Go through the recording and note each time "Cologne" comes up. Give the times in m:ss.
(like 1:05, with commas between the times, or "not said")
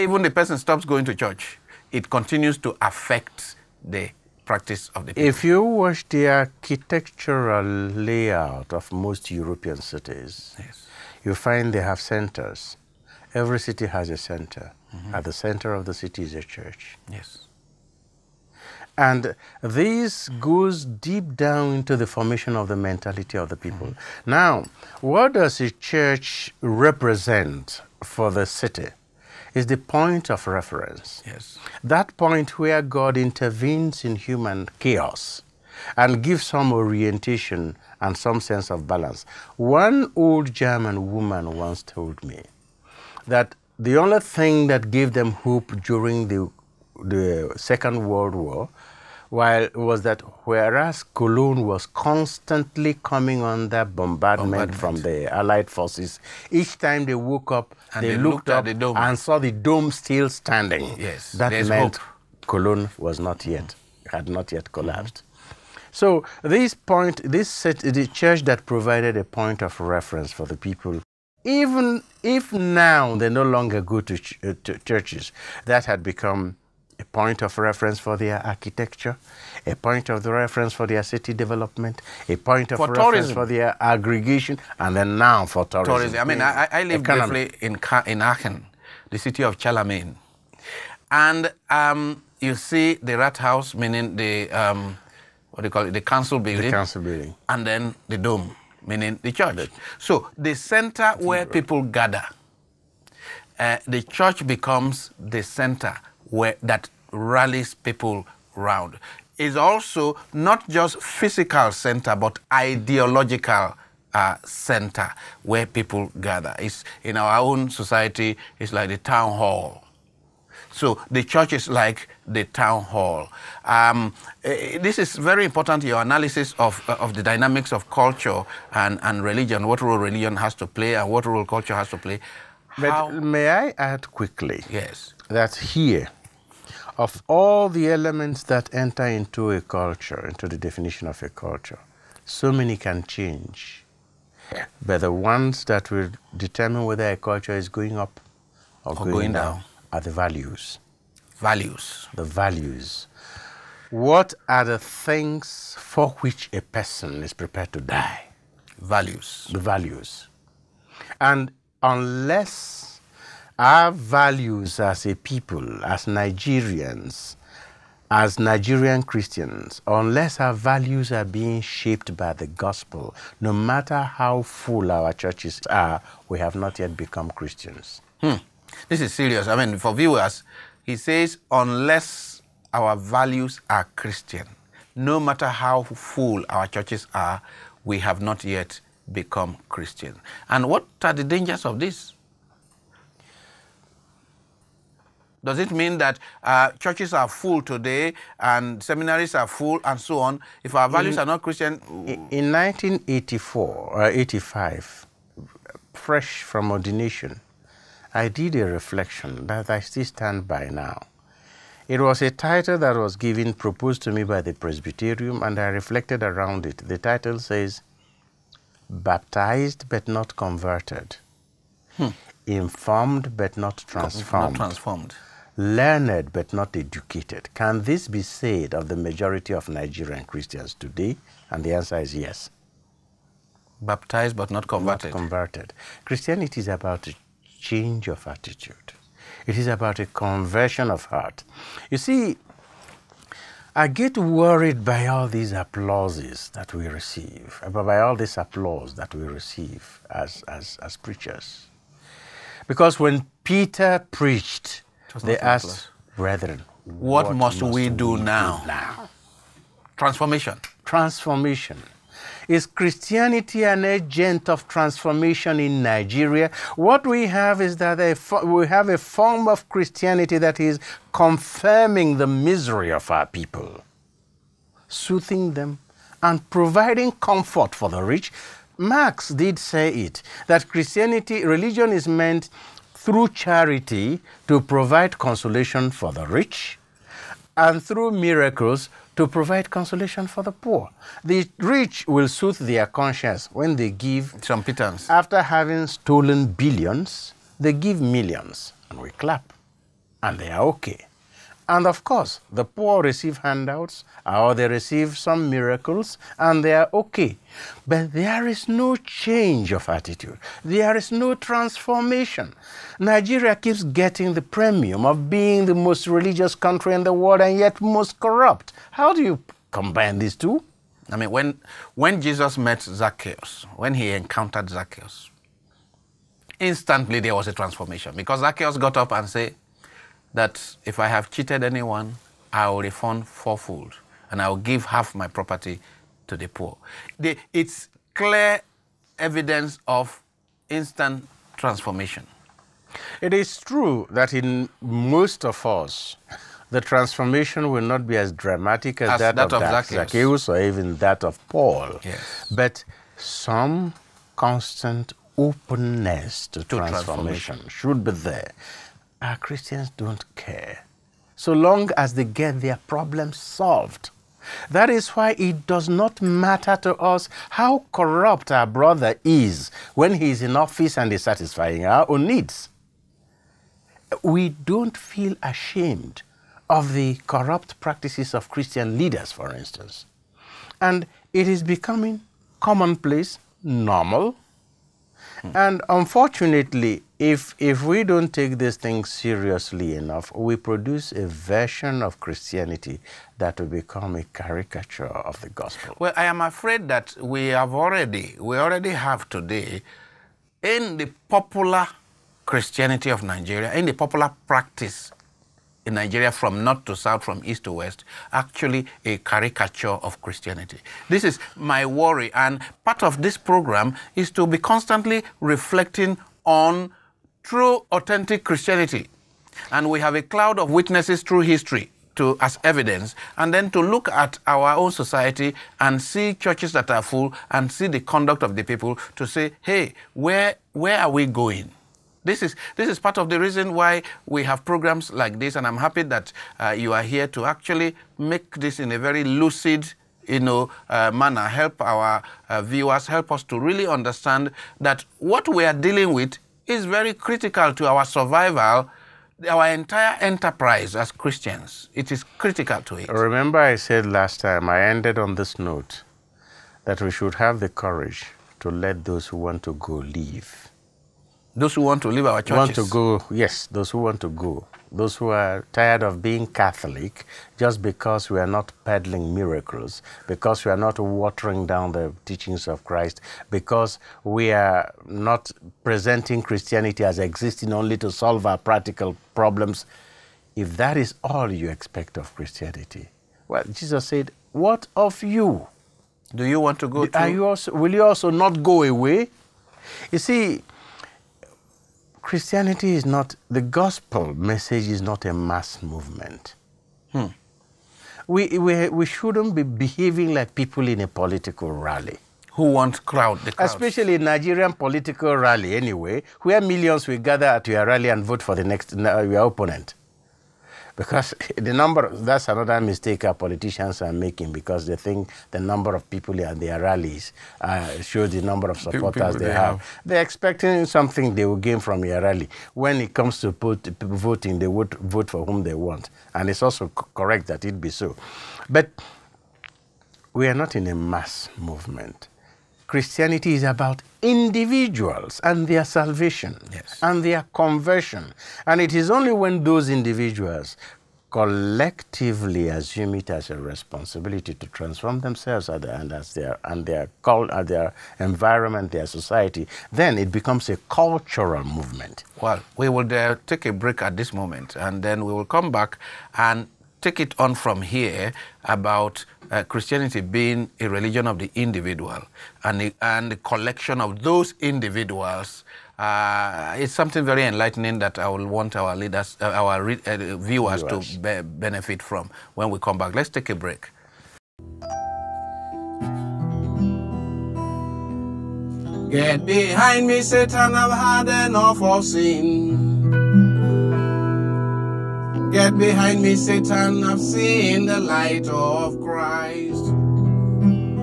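0:51, 1:02.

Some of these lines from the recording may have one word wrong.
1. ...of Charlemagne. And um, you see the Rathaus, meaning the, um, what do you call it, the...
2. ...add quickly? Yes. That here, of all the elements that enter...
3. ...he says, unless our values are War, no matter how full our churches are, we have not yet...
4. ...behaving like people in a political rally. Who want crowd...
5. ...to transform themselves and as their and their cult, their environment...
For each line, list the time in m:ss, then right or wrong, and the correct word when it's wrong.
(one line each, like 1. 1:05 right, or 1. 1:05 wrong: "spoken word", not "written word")
1. 1:29 right
2. 2:13 right
3. 3:00 wrong: "Christian", not "War"
4. 8:19 right
5. 9:04 right.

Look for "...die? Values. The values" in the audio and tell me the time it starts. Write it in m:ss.
2:37.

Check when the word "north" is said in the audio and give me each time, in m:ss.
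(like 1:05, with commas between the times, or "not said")
6:46.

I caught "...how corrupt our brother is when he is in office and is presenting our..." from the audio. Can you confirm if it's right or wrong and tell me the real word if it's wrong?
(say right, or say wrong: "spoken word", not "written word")
wrong: "satisfying", not "presenting".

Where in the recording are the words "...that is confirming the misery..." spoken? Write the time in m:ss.
4:30.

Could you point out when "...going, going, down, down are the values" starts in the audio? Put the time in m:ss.
2:28.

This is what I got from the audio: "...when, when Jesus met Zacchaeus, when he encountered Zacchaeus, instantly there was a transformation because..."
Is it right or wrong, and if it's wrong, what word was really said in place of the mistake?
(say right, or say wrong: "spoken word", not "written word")
right.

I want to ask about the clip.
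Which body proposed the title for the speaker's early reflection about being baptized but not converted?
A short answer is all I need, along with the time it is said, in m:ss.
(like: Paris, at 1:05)
The Presbyterium, at 3:34.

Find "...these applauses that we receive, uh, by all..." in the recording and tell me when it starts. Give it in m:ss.
4:05.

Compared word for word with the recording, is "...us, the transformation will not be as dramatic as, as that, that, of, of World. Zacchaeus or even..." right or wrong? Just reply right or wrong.
wrong.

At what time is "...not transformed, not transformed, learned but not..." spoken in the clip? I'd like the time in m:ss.
3:43.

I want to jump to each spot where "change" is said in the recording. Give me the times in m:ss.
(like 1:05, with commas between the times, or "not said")
2:23, 3:57, 5:08.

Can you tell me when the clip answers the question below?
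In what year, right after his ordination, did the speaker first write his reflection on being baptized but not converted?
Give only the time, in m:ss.
3:22.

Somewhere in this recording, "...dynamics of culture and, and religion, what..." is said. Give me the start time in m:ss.
2:07.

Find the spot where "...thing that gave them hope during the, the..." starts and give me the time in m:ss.
0:44.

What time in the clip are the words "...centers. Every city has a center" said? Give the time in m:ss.
0:11.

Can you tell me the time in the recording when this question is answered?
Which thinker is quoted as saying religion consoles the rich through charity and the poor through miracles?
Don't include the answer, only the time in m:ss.
4:38.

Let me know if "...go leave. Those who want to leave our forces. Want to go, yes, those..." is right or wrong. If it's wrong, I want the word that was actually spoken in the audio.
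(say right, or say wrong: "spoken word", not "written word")
wrong: "churches", not "forces".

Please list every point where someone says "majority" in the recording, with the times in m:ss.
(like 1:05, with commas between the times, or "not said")
3:48.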